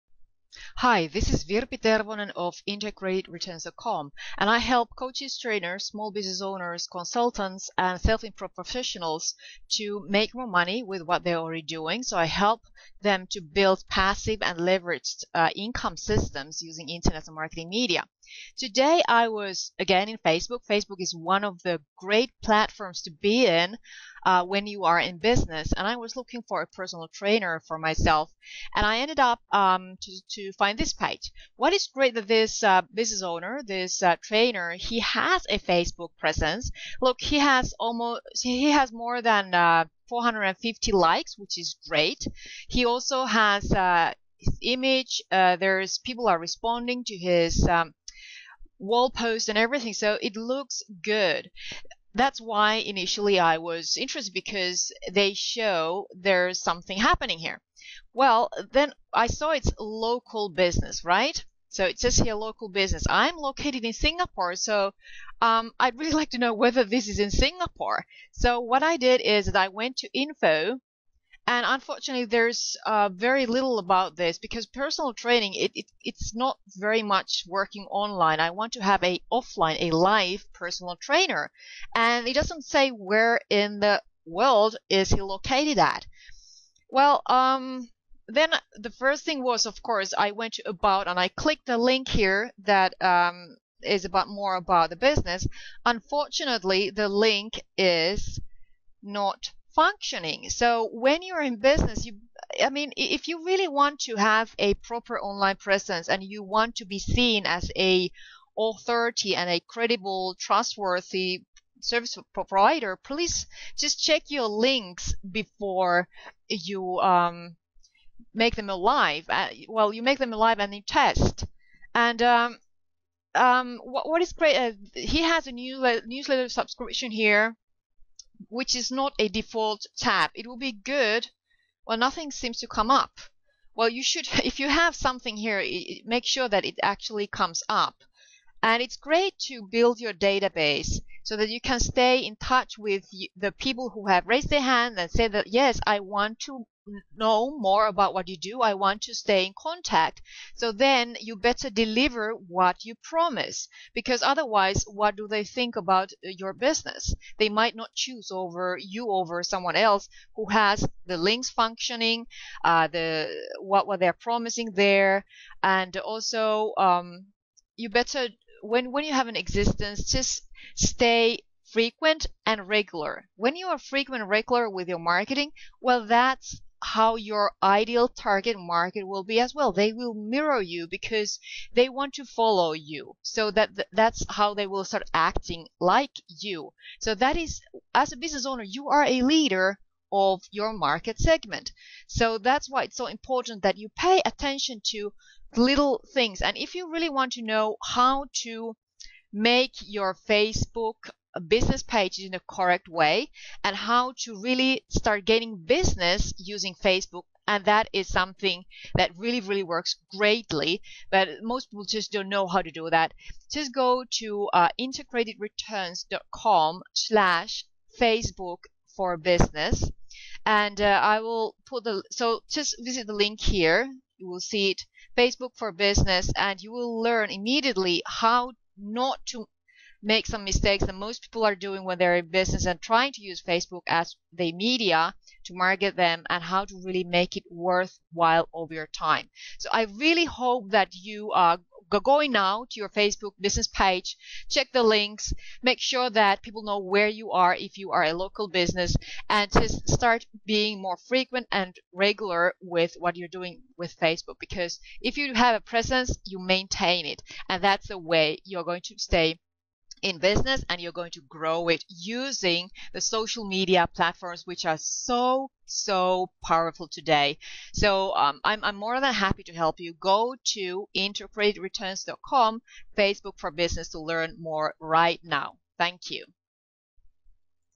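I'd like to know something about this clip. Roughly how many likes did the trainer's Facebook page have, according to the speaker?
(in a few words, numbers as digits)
450.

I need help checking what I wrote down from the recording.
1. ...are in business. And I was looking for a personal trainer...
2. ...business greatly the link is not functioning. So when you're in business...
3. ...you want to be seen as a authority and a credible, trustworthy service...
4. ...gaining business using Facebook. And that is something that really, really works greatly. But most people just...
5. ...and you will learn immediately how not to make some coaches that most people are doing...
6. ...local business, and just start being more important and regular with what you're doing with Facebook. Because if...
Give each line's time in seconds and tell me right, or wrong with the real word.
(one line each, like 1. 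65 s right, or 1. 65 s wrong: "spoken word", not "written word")
1. 24 s right
2. 95 s wrong: "unfortunately", not "greatly"
3. 106 s right
4. 205 s right
5. 226 s wrong: "mistakes", not "coaches"
6. 248 s wrong: "frequent", not "important".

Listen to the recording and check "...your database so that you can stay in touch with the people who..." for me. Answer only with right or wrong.
right.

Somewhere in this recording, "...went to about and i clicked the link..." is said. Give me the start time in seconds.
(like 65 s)
90 s.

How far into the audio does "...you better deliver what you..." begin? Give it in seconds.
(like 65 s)
151 s.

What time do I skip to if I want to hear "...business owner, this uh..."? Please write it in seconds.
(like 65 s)
32 s.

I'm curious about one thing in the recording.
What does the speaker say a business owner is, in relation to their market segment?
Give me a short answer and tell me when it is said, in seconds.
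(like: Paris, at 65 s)
A leader, at 189 s.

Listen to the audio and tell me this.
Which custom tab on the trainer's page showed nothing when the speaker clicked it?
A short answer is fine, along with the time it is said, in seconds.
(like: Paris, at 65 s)
Newsletter subscription, at 126 s.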